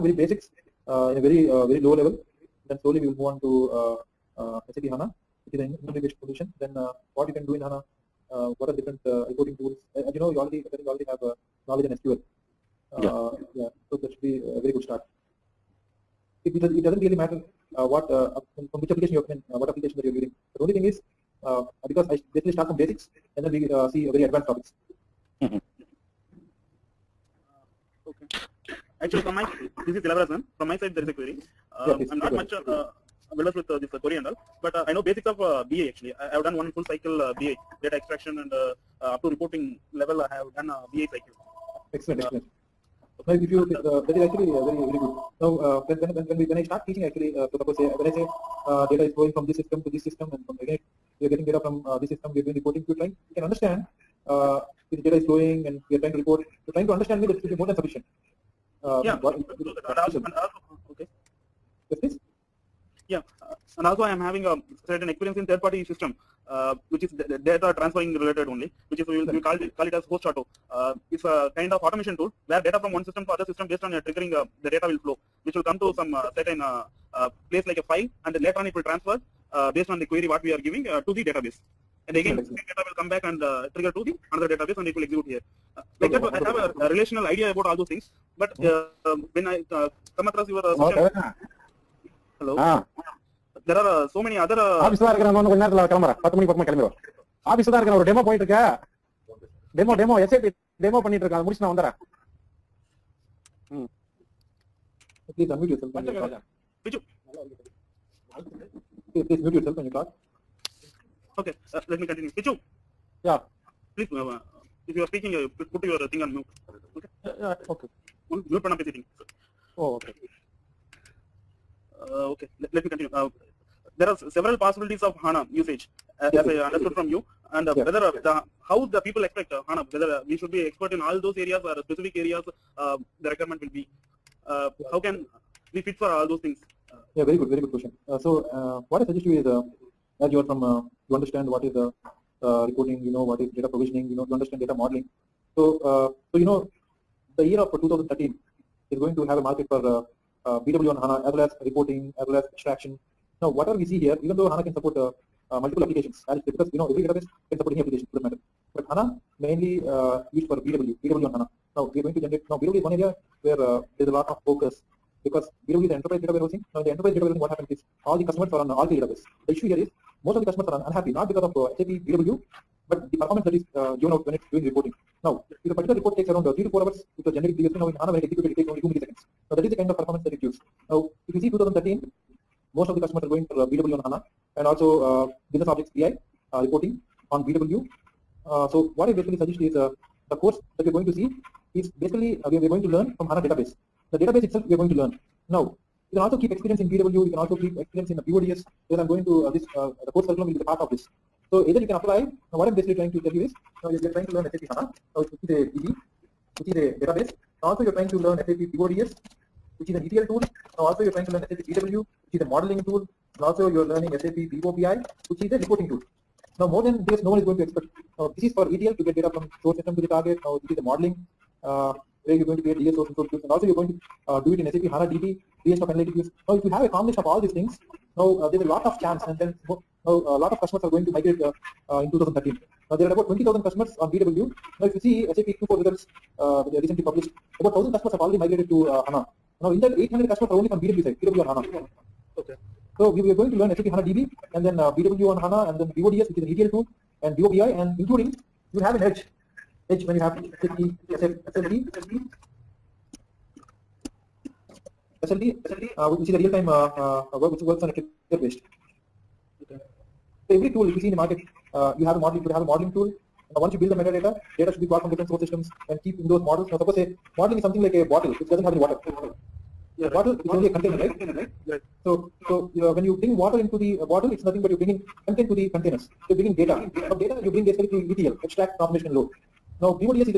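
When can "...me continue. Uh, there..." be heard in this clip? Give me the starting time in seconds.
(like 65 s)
122 s.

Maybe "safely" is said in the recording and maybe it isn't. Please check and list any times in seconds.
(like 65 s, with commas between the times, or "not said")
not said.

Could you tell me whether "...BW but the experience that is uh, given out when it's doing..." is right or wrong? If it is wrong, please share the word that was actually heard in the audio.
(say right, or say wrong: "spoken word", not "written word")
wrong: "performance", not "experience".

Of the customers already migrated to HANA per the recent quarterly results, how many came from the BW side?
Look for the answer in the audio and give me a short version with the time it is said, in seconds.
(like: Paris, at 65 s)
800, at 239 s.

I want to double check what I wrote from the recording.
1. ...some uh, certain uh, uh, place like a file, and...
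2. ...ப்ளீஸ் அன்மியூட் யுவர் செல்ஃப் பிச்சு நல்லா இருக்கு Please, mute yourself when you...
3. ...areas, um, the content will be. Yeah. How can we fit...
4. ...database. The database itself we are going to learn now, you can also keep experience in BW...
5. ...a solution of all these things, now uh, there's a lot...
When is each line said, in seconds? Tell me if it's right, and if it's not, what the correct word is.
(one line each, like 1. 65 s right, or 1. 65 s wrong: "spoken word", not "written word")
1. 75 s right
2. 105 s right
3. 132 s wrong: "requirement", not "content"
4. 193 s right
5. 226 s wrong: "combination", not "solution".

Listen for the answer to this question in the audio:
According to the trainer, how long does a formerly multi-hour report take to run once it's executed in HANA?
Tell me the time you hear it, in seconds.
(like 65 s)
178 s.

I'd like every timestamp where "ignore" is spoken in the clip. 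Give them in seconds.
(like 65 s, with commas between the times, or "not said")
not said.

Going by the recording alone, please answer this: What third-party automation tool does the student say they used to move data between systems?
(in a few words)
host auto.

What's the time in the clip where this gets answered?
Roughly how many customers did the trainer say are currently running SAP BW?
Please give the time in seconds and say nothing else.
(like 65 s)
233 s.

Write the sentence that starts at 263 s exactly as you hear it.
once you build the metadata, data should be brought from different source systems and keep in those models.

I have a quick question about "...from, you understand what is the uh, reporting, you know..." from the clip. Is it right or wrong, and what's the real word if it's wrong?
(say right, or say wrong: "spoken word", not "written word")
right.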